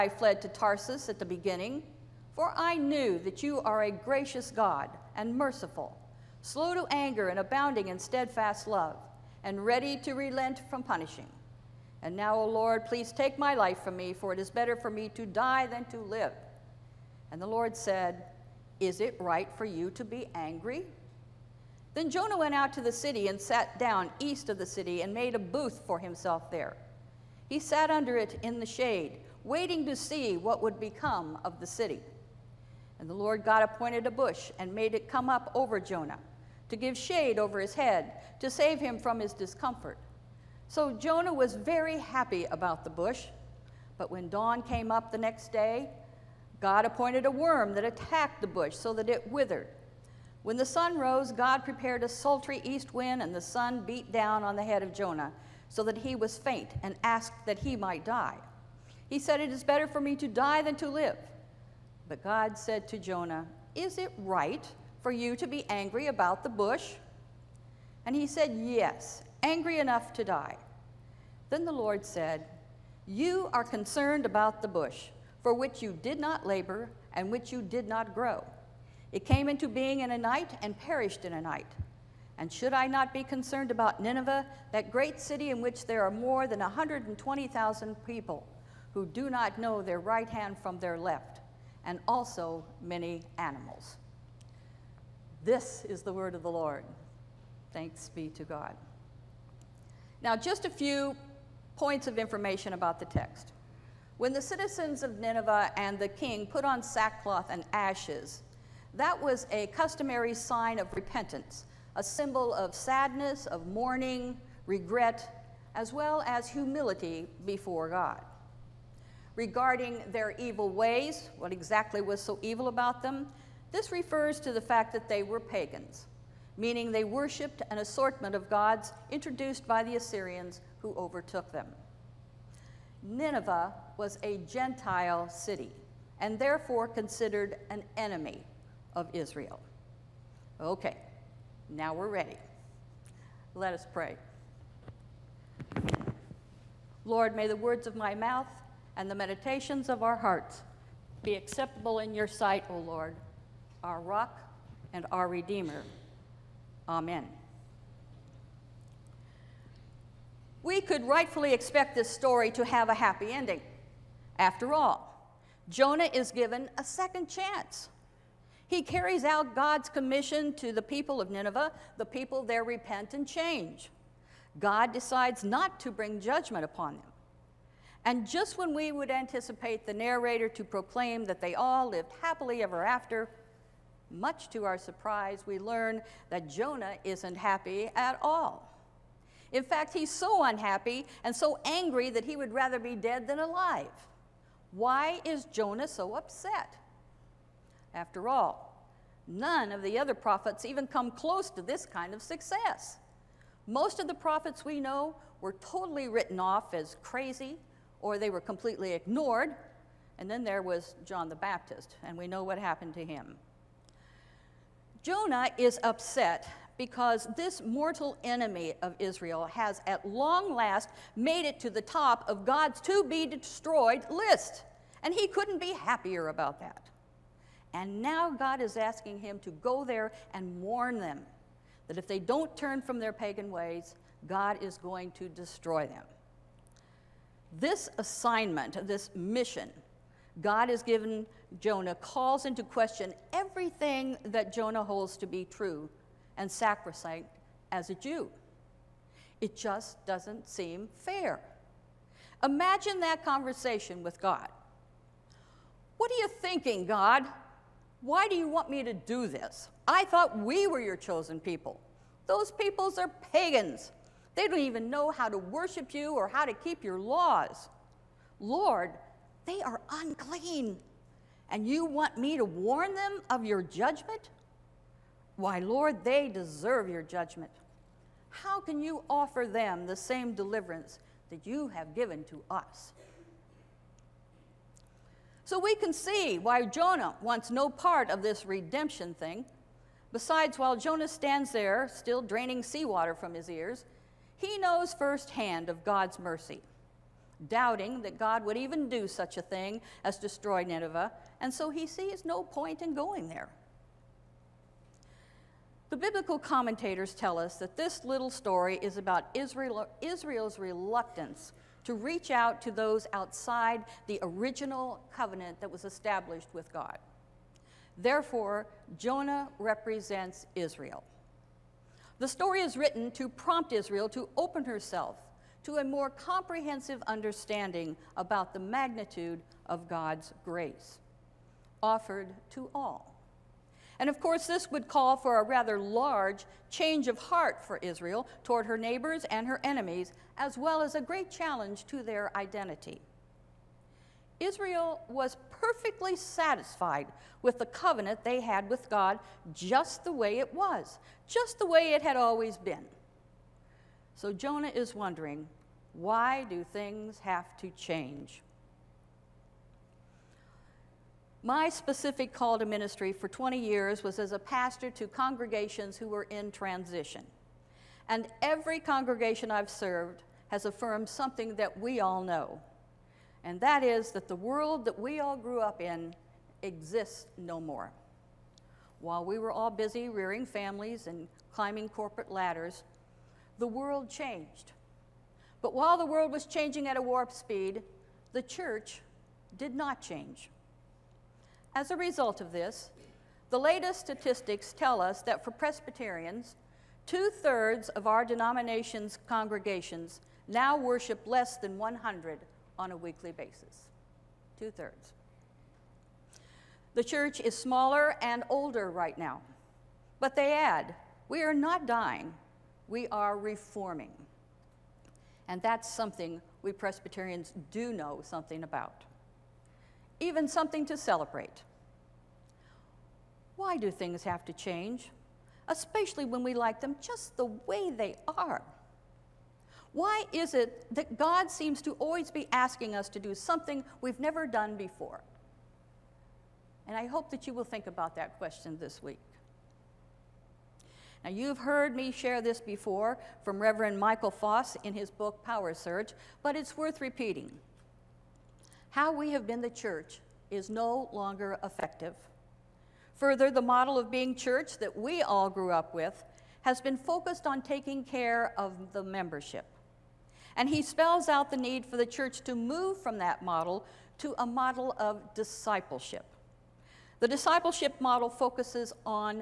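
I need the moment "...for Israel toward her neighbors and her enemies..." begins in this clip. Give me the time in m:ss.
5:37.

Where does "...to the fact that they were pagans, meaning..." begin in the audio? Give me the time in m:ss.
2:04.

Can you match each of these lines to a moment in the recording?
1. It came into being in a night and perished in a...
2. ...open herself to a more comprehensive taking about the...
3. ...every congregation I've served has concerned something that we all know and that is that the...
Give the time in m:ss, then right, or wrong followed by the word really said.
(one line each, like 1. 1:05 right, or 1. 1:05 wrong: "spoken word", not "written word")
1. 1:19 right
2. 5:24 wrong: "understanding", not "taking"
3. 6:08 wrong: "affirmed", not "concerned".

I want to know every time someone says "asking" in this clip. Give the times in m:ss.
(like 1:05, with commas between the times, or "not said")
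3:48, 7:12.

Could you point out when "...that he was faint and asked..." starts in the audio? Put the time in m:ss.
0:55.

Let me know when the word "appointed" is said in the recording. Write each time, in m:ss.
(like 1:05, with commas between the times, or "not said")
0:33, 0:46.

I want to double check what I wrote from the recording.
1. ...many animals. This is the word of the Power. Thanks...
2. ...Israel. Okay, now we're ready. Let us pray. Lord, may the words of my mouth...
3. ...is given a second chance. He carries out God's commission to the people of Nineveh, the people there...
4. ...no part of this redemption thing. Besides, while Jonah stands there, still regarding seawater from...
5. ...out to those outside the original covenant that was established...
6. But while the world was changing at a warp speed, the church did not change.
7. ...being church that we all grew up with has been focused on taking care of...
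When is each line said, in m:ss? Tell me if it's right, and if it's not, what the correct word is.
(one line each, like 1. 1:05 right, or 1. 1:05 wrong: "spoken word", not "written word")
1. 1:32 wrong: "Lord", not "Power"
2. 2:19 right
3. 2:46 right
4. 4:47 wrong: "draining", not "regarding"
5. 5:12 right
6. 6:25 right
7. 7:34 right.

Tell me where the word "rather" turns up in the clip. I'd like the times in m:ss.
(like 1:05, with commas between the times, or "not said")
3:12, 5:35.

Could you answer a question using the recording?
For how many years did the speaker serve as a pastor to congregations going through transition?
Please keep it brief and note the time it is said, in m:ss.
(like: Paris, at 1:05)
20 years, at 6:03.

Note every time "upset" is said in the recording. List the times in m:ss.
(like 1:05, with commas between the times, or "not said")
3:16, 3:35.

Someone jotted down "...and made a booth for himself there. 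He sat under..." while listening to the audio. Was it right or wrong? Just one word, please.
right.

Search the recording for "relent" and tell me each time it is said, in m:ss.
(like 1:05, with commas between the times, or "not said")
0:10.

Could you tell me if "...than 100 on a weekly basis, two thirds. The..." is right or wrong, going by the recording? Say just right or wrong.
right.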